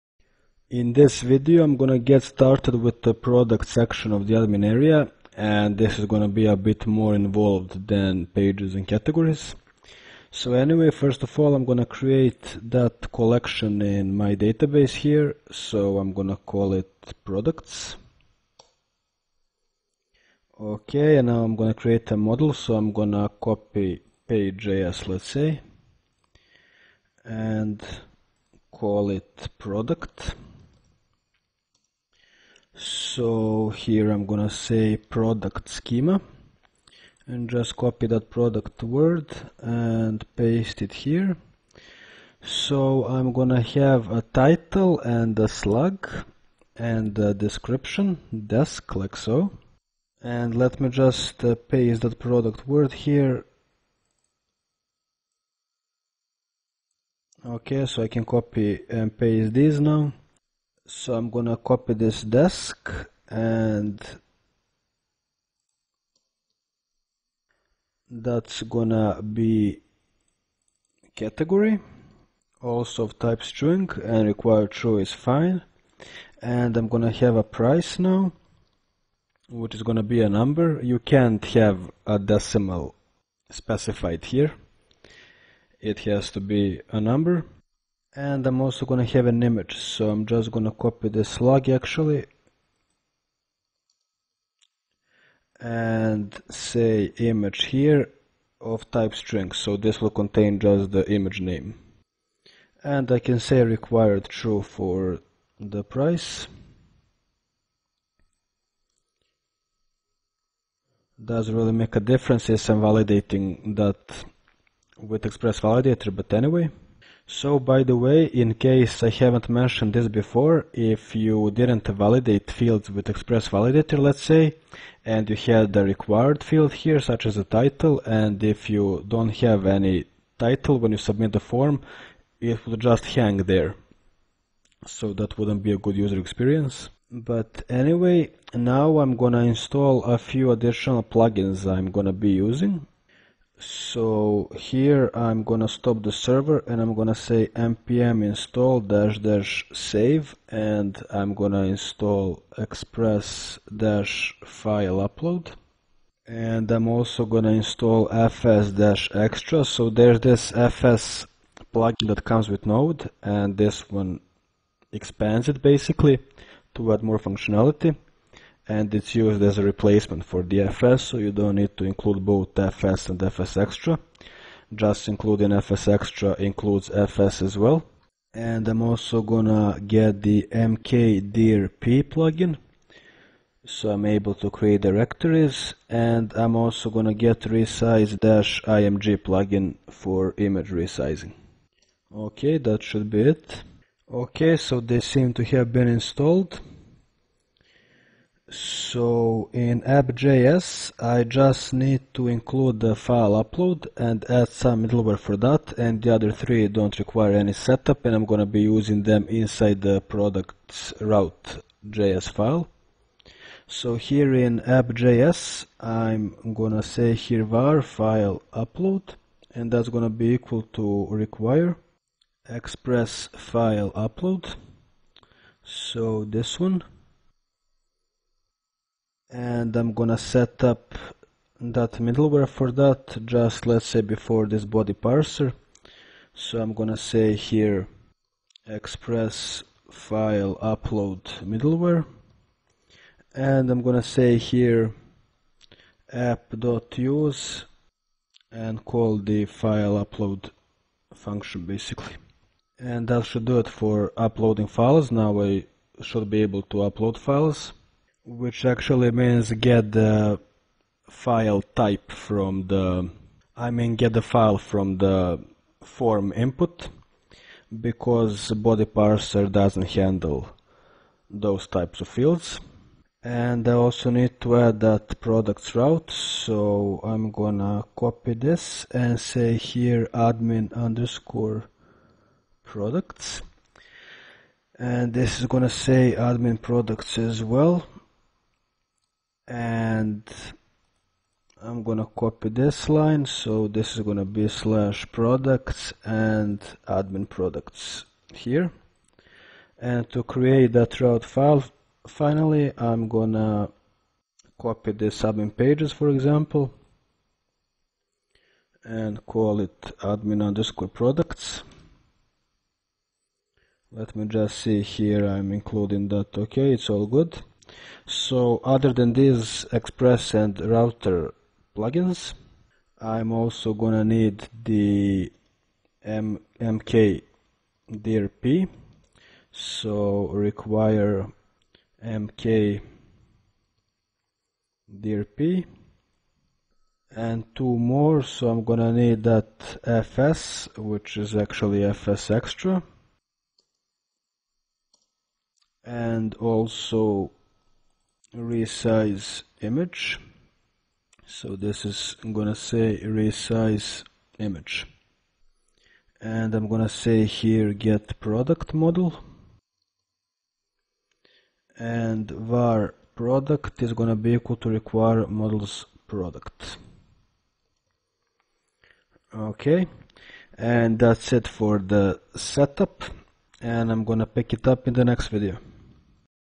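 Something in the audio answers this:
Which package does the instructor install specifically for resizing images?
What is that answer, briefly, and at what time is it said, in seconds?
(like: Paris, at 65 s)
resize-img, at 187 s.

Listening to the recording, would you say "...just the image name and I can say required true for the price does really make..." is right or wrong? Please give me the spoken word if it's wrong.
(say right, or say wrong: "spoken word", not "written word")
right.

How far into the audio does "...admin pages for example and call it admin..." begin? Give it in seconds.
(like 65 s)
305 s.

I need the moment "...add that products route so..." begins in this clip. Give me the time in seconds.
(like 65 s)
274 s.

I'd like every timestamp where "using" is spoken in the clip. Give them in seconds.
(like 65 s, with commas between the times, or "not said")
142 s, 208 s.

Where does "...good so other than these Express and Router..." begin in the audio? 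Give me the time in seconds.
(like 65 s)
317 s.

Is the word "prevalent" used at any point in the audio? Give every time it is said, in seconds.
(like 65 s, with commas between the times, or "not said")
not said.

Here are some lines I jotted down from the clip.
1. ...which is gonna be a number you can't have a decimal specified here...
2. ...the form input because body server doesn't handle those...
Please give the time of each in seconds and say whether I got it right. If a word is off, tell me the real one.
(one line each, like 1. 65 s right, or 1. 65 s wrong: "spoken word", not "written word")
1. 79 s right
2. 264 s wrong: "parser", not "server".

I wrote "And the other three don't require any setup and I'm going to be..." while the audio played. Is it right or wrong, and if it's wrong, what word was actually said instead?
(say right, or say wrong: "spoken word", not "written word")
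right.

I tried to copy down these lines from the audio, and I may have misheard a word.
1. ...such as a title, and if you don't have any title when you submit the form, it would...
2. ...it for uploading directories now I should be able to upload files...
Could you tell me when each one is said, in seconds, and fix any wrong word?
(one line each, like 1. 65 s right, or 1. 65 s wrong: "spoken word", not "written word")
1. 126 s right
2. 253 s wrong: "files", not "directories".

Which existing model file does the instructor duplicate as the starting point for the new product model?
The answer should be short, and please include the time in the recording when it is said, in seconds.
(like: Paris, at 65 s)
page.js, at 24 s.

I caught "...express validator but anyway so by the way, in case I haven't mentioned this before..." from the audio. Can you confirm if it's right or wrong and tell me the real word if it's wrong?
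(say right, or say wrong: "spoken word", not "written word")
right.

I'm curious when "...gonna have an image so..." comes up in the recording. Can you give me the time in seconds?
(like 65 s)
88 s.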